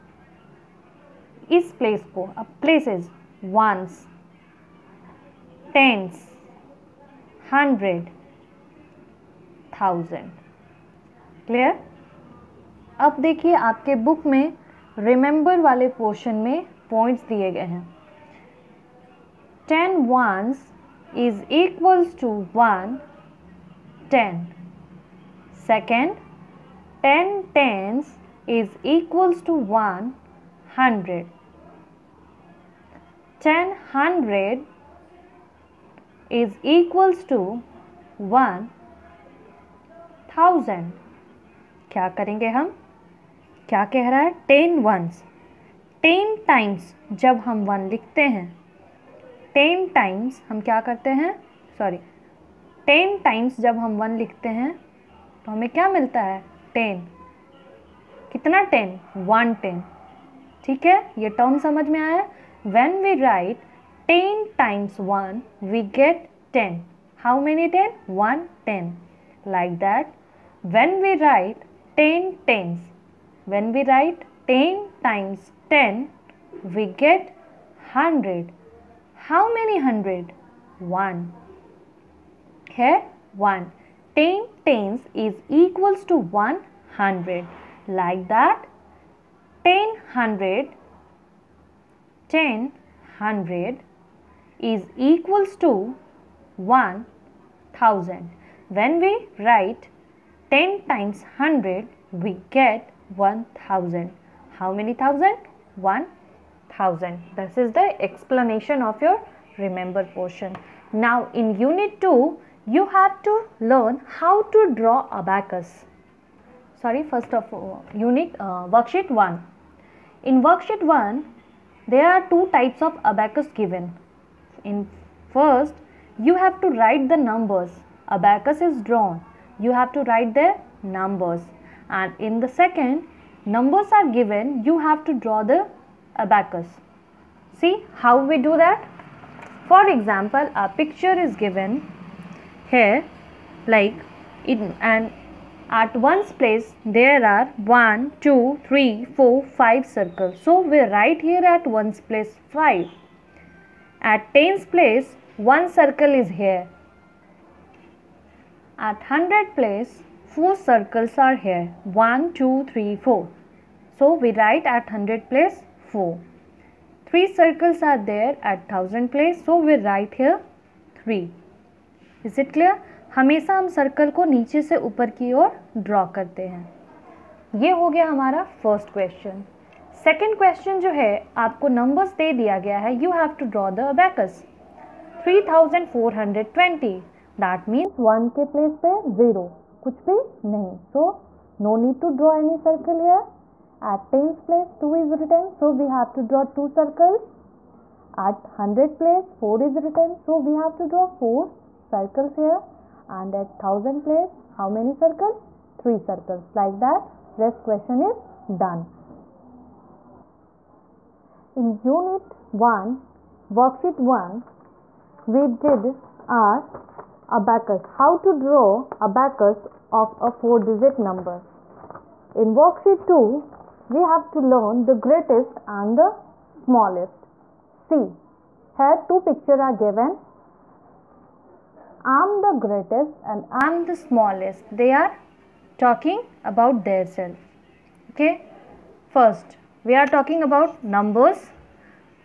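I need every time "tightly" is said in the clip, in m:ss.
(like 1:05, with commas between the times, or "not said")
not said.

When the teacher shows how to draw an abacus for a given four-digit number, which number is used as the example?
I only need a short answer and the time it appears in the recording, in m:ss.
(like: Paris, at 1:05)
3420, at 3:05.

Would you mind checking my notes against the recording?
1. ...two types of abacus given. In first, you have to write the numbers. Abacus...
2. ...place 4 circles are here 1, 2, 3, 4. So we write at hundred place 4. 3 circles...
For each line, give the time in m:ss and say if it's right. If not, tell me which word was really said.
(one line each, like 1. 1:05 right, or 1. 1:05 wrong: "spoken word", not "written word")
1. 2:02 right
2. 2:39 right.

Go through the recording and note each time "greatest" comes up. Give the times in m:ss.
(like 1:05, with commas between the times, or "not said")
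3:45, 3:52.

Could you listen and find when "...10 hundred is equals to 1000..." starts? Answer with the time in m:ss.
1:32.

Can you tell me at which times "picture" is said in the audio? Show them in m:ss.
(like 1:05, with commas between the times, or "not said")
2:20, 3:49.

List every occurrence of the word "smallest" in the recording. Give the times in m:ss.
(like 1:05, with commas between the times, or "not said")
3:46, 3:53.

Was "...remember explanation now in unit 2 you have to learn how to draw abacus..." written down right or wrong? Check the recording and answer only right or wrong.
wrong.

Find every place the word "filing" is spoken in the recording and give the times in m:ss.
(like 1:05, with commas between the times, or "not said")
not said.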